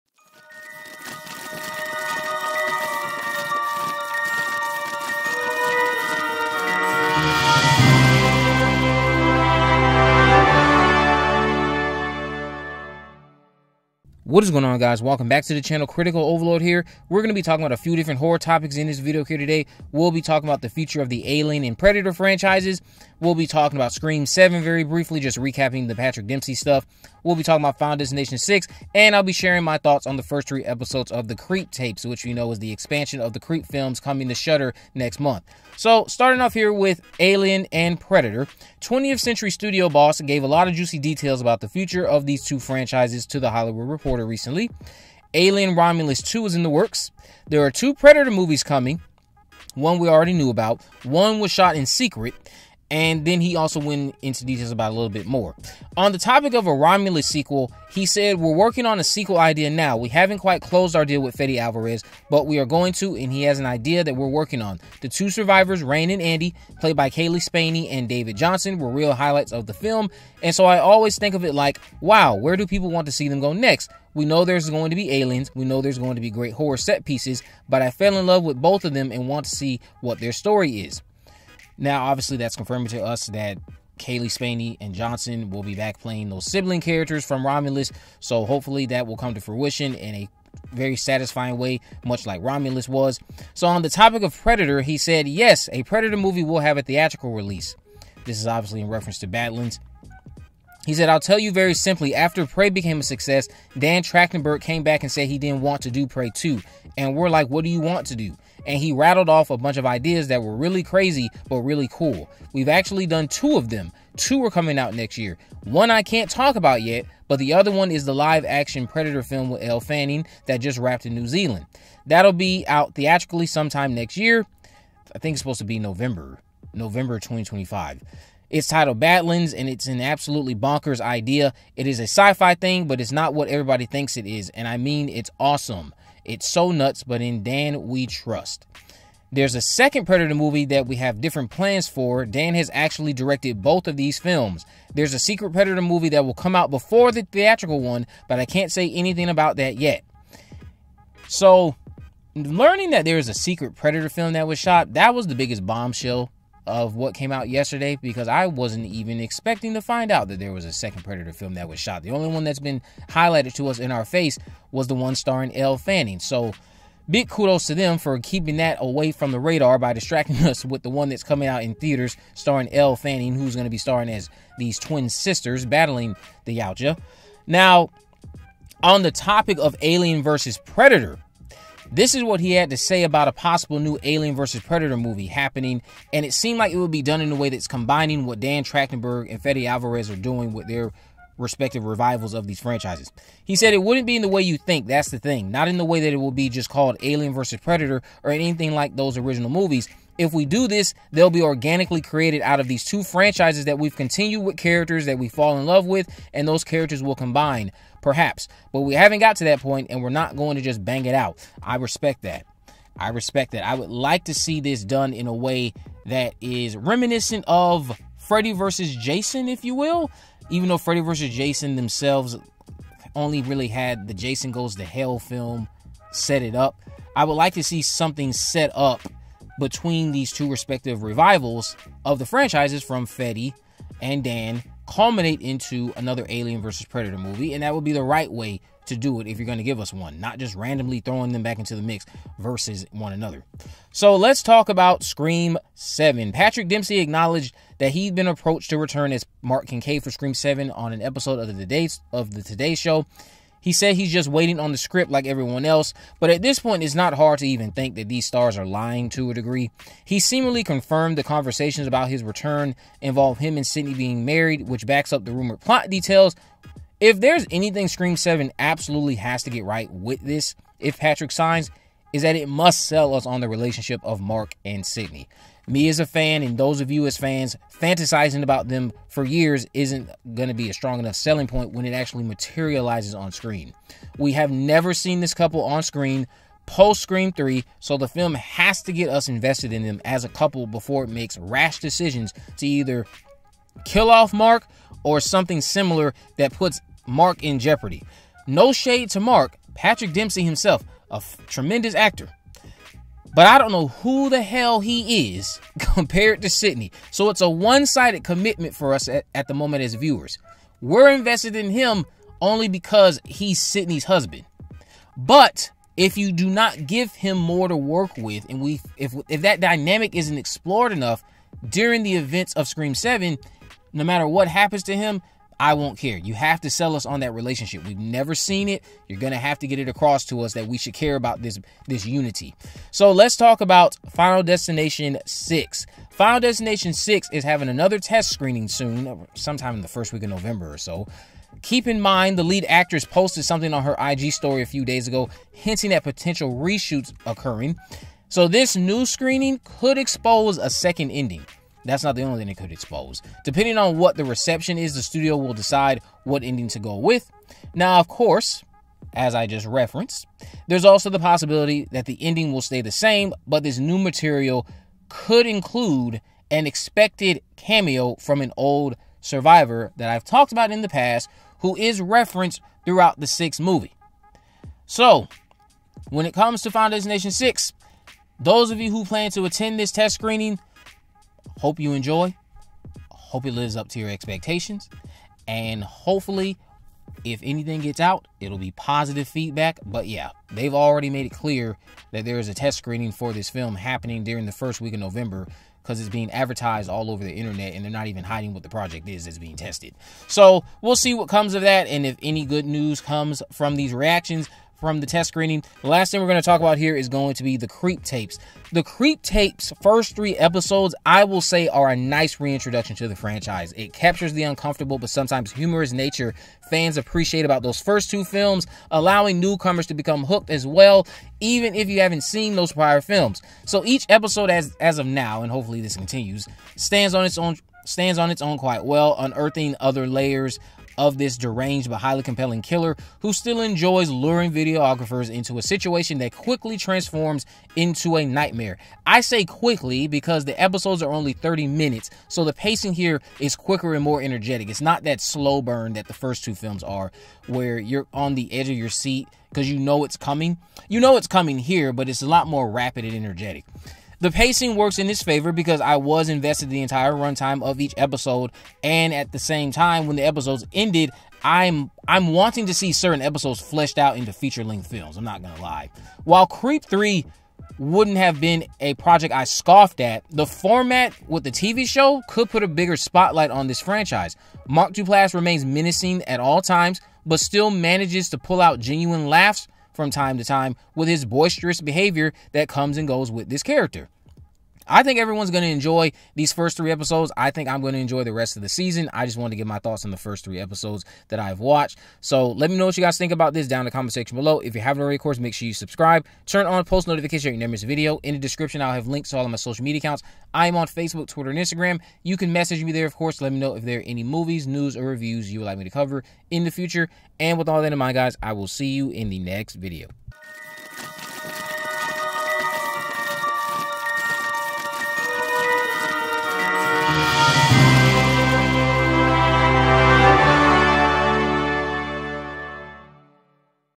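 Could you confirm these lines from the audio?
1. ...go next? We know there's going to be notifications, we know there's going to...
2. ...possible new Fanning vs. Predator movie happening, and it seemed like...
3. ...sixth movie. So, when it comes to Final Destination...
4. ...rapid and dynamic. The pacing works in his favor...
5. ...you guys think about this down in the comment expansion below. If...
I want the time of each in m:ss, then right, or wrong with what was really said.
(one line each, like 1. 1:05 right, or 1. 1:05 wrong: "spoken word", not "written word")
1. 1:13 wrong: "aliens", not "notifications"
2. 3:03 wrong: "Alien", not "Fanning"
3. 6:13 right
4. 7:32 wrong: "energetic", not "dynamic"
5. 8:12 wrong: "section", not "expansion".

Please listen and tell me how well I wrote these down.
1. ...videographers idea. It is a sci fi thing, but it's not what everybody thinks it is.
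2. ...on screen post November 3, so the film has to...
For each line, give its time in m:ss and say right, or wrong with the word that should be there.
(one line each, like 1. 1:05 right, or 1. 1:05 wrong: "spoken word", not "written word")
1. 2:10 wrong: "bonkers", not "videographers"
2. 4:45 wrong: "Scream", not "November".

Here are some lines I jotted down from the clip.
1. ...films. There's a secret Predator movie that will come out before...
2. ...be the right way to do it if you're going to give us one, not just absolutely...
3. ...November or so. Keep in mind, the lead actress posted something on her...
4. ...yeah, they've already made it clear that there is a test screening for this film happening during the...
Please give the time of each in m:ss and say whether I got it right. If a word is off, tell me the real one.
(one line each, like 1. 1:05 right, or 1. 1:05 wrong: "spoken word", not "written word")
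1. 2:24 right
2. 3:57 wrong: "randomly", not "absolutely"
3. 5:40 right
4. 6:30 right.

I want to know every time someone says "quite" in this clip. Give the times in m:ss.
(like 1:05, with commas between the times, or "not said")
1:00, 7:08.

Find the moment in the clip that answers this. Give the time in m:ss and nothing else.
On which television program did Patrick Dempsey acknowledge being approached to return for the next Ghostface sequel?
4:12.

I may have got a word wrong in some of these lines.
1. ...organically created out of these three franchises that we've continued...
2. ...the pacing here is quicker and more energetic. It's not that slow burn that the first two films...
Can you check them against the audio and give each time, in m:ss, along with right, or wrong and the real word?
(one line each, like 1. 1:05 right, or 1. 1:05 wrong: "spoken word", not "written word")
1. 3:21 wrong: "two", not "three"
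2. 7:22 right.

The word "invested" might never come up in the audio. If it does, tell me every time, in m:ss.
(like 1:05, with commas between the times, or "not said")
4:49, 5:11, 7:36.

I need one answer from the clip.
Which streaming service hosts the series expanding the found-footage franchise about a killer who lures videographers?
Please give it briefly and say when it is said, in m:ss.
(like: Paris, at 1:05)
Shudder, at 0:34.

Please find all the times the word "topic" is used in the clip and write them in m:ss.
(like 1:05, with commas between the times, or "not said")
0:18, 0:56, 1:33, 2:59.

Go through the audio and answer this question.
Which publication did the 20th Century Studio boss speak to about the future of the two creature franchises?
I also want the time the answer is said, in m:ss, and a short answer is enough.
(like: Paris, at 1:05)
The Hollywood Reporter, at 0:43.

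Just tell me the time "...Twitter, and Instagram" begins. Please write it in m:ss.
8:21.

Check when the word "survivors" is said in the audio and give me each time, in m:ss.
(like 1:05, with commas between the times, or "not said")
1:05, 6:09.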